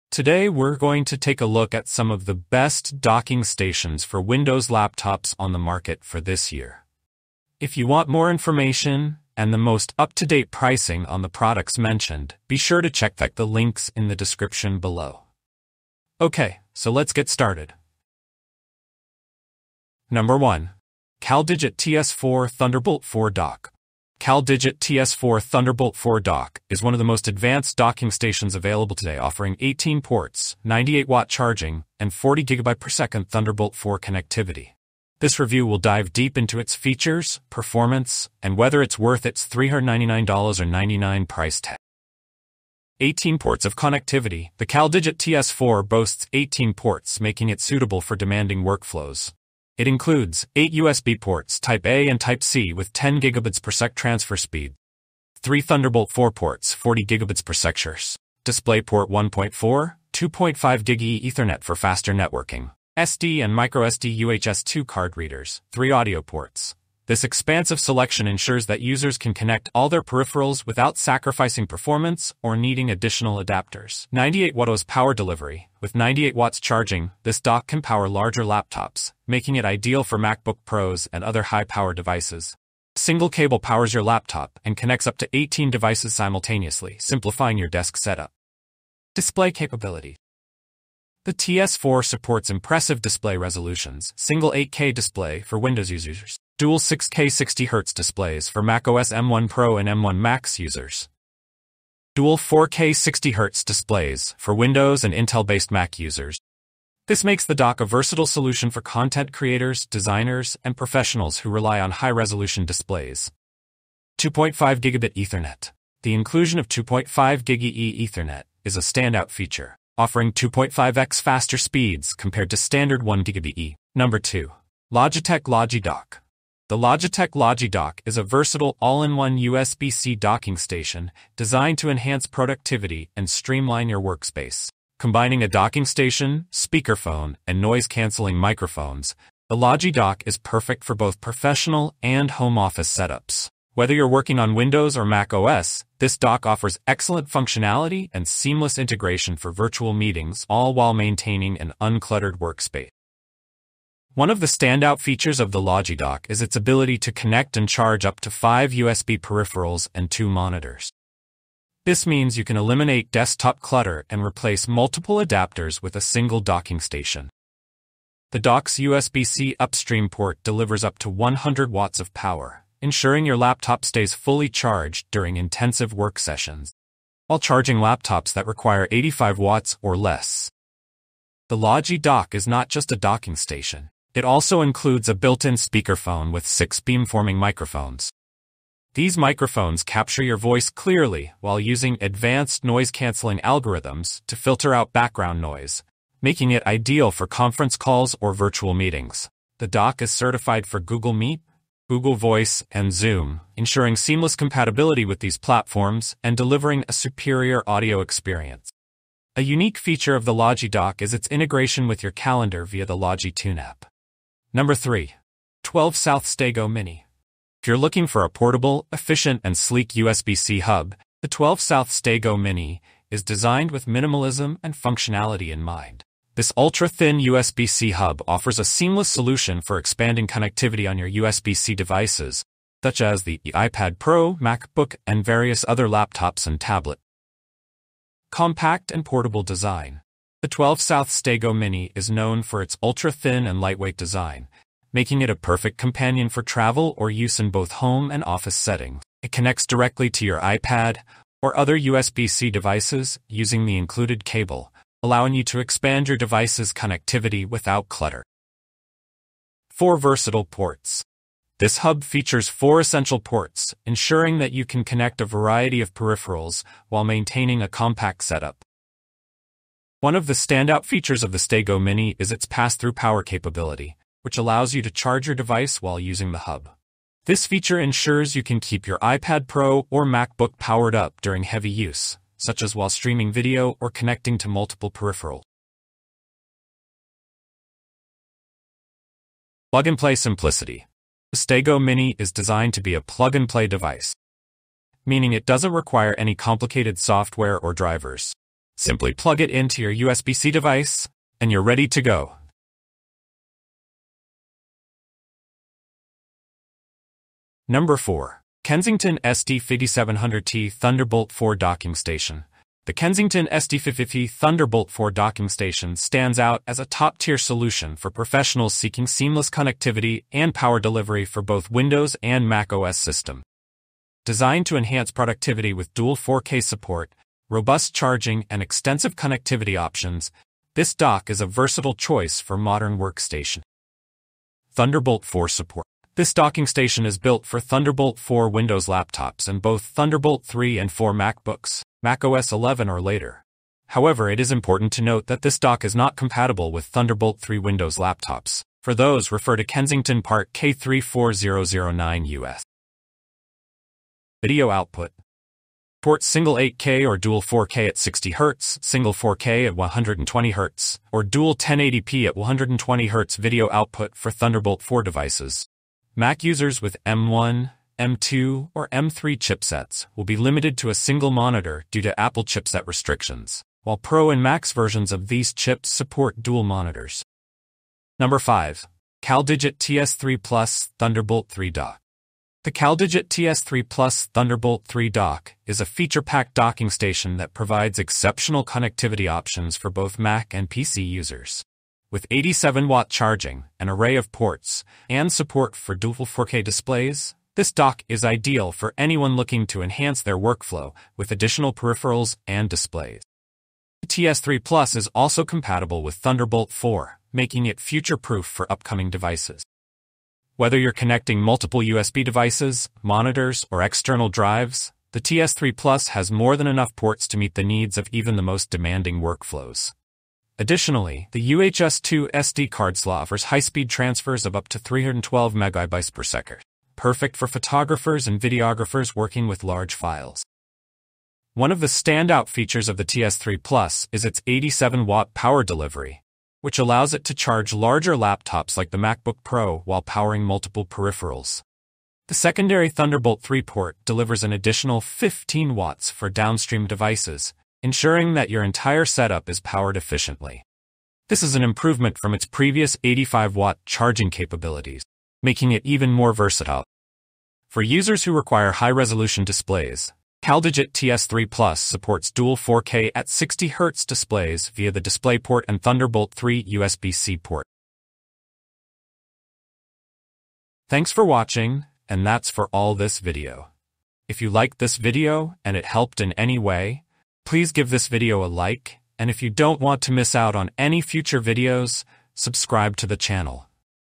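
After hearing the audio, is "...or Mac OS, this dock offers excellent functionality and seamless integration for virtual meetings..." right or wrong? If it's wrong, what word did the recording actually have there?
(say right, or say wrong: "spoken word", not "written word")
right.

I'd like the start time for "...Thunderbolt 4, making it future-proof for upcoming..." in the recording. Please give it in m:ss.
6:46.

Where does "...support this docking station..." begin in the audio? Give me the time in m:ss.
5:35.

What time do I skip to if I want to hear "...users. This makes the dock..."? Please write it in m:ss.
1:45.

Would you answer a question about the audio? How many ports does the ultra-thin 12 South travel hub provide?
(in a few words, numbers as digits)
4.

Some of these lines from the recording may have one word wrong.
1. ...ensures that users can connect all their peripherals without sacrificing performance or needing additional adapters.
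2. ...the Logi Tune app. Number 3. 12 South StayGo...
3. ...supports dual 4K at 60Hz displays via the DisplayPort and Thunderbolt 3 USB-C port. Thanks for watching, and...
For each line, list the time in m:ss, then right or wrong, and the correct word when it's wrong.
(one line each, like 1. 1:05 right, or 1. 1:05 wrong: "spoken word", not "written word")
1. 1:08 right
2. 3:32 right
3. 7:41 right.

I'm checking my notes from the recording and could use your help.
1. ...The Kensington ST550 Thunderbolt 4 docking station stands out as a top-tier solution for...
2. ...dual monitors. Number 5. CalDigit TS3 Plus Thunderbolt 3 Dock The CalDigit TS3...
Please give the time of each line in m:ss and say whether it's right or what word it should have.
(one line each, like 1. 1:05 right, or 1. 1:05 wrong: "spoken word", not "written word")
1. 5:12 right
2. 6:16 right.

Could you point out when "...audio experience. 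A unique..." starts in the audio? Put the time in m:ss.
3:27.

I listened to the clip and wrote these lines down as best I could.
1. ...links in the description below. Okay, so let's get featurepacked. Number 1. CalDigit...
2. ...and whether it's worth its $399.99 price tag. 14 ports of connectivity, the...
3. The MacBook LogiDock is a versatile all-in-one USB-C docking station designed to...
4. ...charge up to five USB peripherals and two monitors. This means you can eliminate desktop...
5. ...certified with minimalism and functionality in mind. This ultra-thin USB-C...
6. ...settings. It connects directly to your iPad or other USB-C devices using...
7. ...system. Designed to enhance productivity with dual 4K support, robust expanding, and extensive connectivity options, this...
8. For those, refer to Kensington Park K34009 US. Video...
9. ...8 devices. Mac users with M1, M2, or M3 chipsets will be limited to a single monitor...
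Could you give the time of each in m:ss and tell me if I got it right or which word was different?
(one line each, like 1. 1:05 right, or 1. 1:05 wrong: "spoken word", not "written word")
1. 0:13 wrong: "started", not "featurepacked"
2. 0:38 wrong: "18", not "14"
3. 2:06 wrong: "Logitech", not "MacBook"
4. 2:37 right
5. 3:43 wrong: "designed", not "certified"
6. 4:08 right
7. 5:22 wrong: "charging", not "expanding"
8. 5:48 right
9. 6:04 wrong: "4", not "8".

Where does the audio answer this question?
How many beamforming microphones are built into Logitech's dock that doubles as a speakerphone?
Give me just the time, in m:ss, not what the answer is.
3:06.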